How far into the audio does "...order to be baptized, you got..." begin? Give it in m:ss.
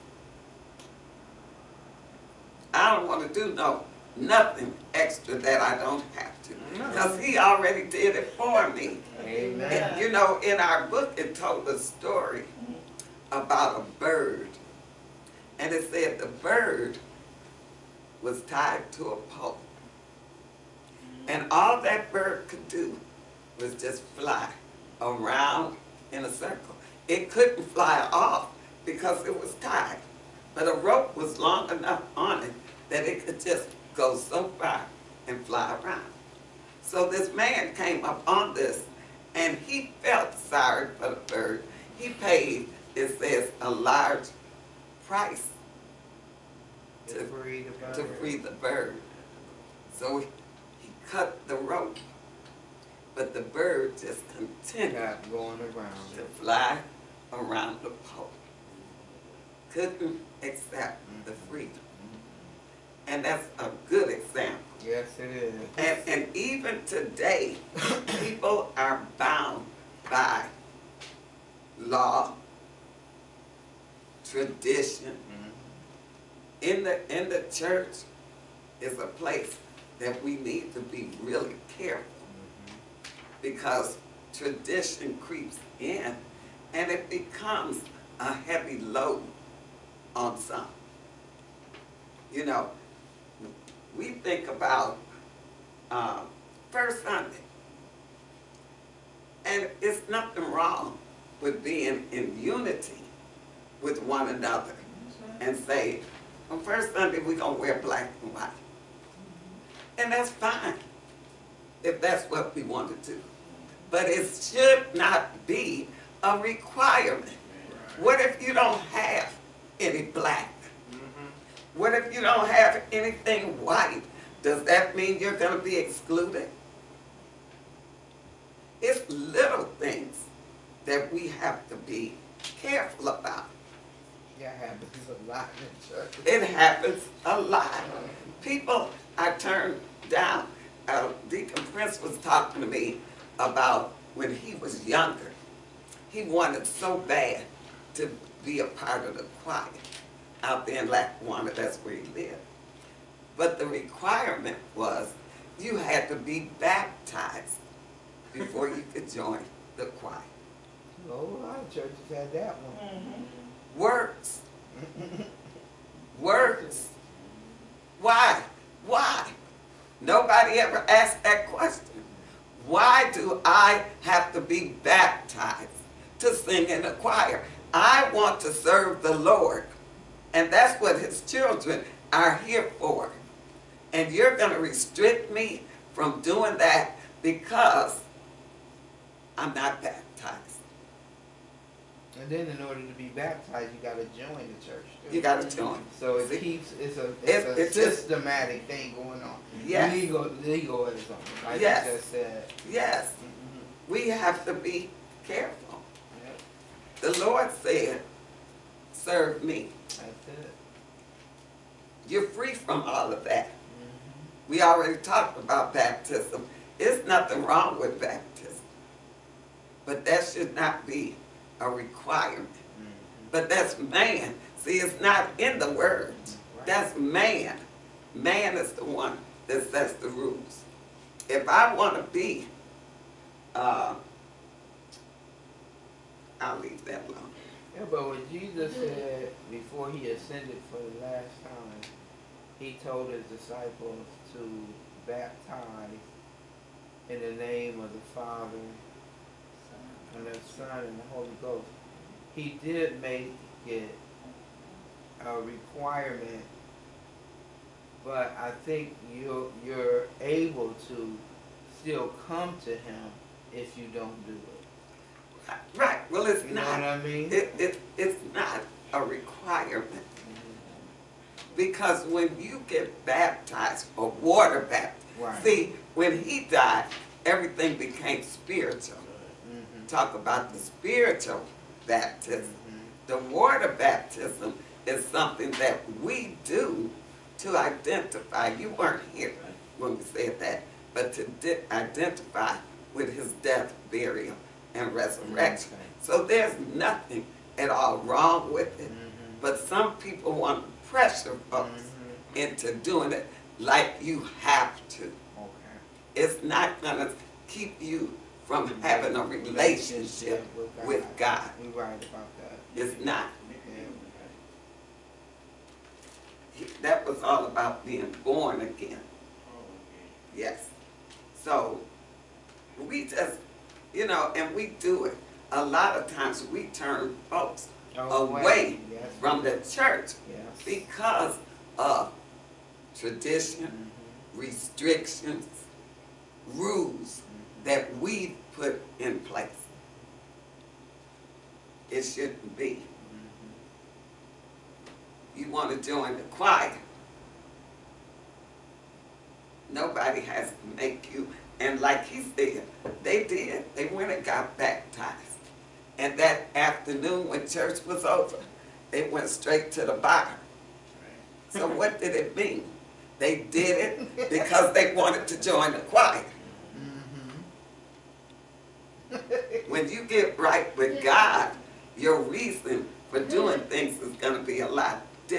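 3:12.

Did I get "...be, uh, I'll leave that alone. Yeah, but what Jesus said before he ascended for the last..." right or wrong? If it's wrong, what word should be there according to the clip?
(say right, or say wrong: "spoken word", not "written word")
right.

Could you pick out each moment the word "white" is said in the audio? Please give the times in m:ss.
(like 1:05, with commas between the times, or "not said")
1:48, 2:03.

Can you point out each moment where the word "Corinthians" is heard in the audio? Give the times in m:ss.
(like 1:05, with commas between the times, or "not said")
not said.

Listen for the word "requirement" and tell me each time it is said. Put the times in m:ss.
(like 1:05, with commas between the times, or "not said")
1:56, 2:33, 3:41, 4:15, 4:29.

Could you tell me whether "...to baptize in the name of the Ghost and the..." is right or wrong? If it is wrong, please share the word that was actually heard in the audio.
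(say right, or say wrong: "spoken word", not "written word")
wrong: "Father", not "Ghost".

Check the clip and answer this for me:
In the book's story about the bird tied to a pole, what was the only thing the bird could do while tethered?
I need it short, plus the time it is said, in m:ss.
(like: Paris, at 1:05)
Fly around in a circle, at 0:24.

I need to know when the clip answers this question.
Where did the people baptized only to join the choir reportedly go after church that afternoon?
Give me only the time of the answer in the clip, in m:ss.
5:59.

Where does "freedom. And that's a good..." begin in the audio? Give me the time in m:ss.
1:01.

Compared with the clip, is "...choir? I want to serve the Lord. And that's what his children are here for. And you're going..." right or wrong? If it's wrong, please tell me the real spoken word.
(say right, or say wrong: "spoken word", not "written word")
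right.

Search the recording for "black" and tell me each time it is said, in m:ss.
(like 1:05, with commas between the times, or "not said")
1:47, 2:00.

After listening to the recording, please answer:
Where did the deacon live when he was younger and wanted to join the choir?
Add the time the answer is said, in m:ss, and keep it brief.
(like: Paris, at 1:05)
Lackawanna, at 2:30.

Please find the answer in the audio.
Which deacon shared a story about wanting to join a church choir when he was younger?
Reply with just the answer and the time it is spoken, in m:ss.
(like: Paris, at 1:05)
Deacon Prince, at 2:21.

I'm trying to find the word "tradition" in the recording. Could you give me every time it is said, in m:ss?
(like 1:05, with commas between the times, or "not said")
1:14, 1:24, 5:32.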